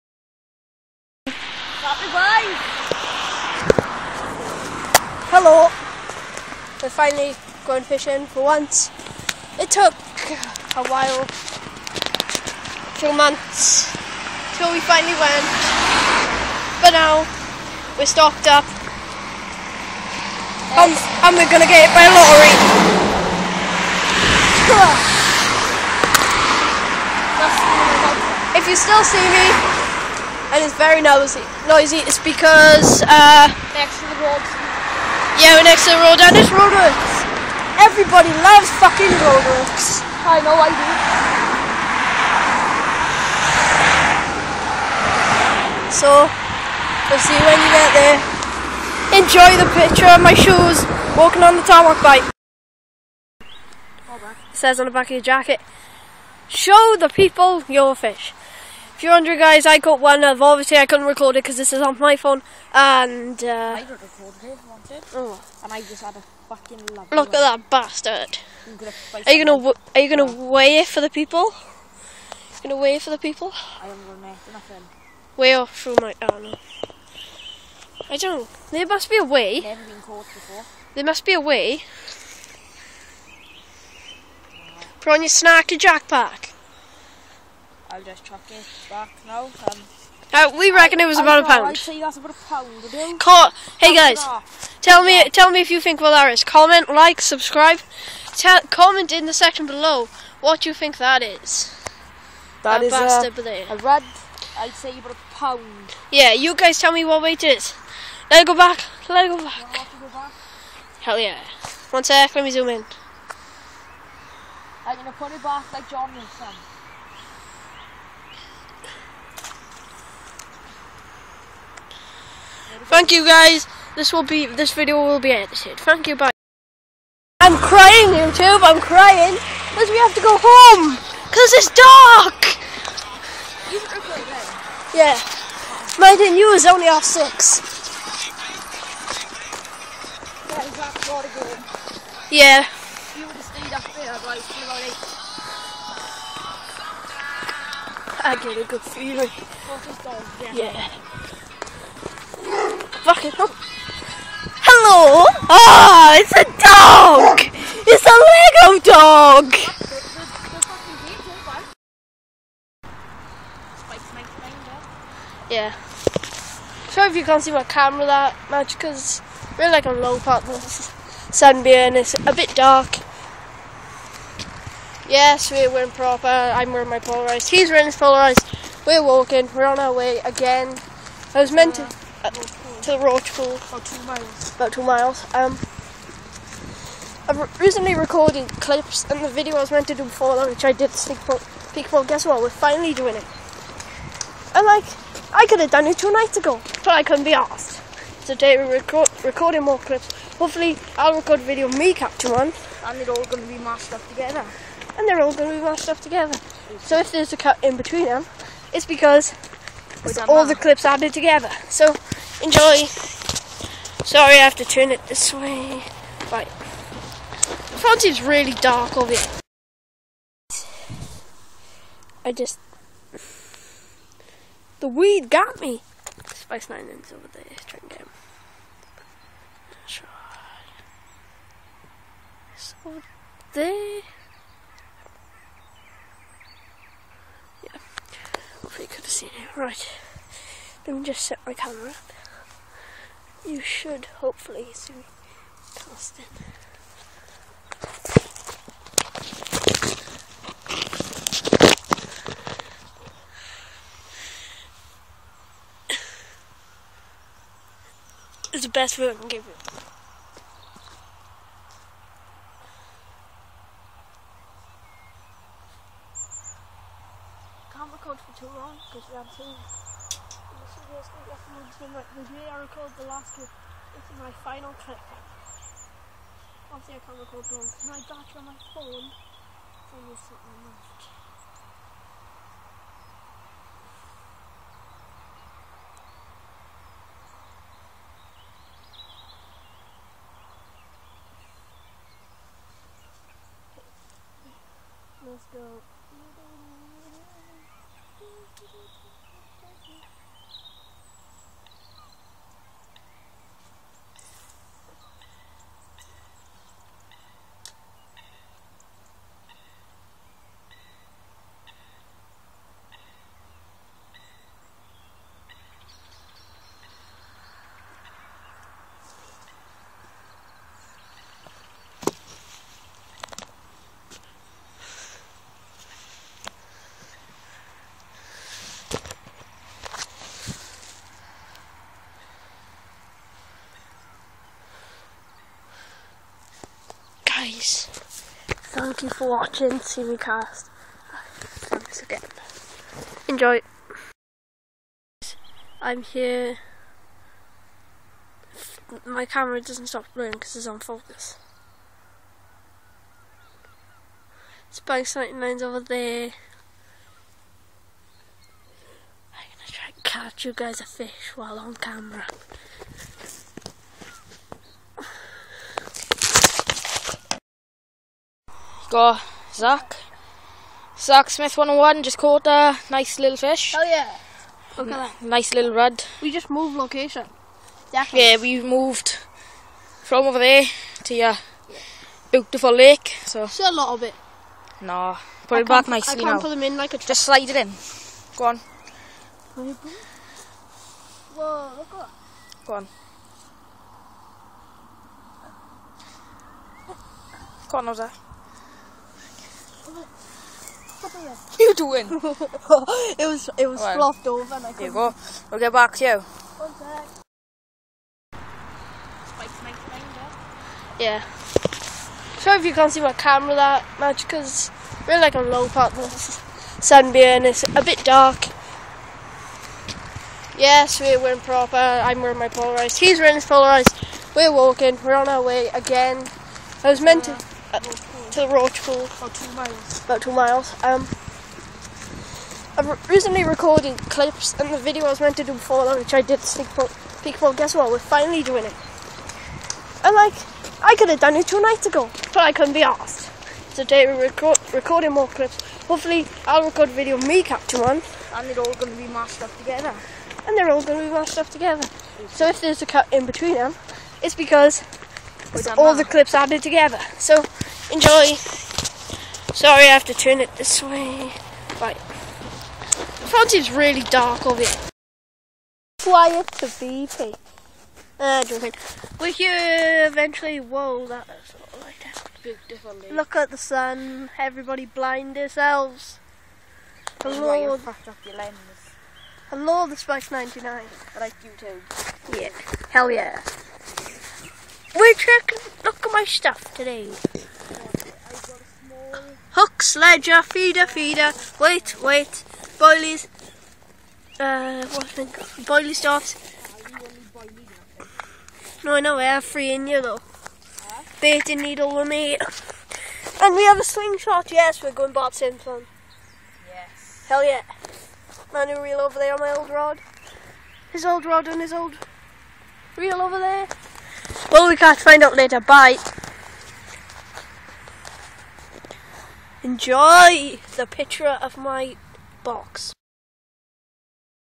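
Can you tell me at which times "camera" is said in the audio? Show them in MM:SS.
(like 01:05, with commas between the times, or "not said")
02:47, 04:01, 05:49, 06:01, 06:53.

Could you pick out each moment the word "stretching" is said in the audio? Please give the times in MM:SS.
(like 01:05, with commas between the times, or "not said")
not said.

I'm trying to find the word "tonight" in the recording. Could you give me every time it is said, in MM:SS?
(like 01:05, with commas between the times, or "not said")
not said.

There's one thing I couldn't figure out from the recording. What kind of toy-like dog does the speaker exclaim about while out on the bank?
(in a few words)
Lego dog.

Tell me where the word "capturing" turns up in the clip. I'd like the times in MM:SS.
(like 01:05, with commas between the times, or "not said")
03:21, 07:27.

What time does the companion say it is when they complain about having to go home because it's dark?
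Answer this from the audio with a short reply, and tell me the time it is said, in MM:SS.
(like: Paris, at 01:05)
half six, at 02:16.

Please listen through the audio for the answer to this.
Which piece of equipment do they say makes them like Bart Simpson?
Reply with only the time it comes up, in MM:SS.
08:23.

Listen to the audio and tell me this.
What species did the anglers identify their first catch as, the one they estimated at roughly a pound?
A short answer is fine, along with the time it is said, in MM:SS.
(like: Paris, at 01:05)
rudd, at 01:43.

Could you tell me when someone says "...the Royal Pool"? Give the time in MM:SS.
07:08.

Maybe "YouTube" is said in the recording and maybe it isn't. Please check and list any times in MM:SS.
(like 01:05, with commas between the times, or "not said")
02:08, 08:01.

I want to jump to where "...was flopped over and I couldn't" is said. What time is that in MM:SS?
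06:43.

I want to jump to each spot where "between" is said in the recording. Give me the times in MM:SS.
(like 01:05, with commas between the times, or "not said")
03:27, 07:33.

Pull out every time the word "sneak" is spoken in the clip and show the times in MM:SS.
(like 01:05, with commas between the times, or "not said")
03:10, 07:16.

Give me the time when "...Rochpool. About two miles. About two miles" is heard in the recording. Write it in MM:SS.
03:02.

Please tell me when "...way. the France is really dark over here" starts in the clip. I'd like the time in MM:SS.
03:35.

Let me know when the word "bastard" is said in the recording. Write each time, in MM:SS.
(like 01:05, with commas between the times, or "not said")
01:07, 01:42.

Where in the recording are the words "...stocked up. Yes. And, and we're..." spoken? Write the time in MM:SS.
00:18.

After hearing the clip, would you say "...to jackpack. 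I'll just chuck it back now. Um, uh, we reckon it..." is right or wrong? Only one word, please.
right.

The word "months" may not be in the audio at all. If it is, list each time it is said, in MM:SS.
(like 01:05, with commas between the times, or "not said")
00:13.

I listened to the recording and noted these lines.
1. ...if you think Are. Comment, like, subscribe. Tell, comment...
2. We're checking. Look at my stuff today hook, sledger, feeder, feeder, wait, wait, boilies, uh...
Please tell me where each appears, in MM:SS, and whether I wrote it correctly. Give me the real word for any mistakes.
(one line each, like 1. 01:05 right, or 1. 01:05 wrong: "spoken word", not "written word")
1. 01:35 wrong: "Valaris", not "Are"
2. 08:04 right.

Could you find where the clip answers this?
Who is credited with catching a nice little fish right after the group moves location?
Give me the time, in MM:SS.
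06:10.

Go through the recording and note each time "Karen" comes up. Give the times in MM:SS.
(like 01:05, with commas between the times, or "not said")
not said.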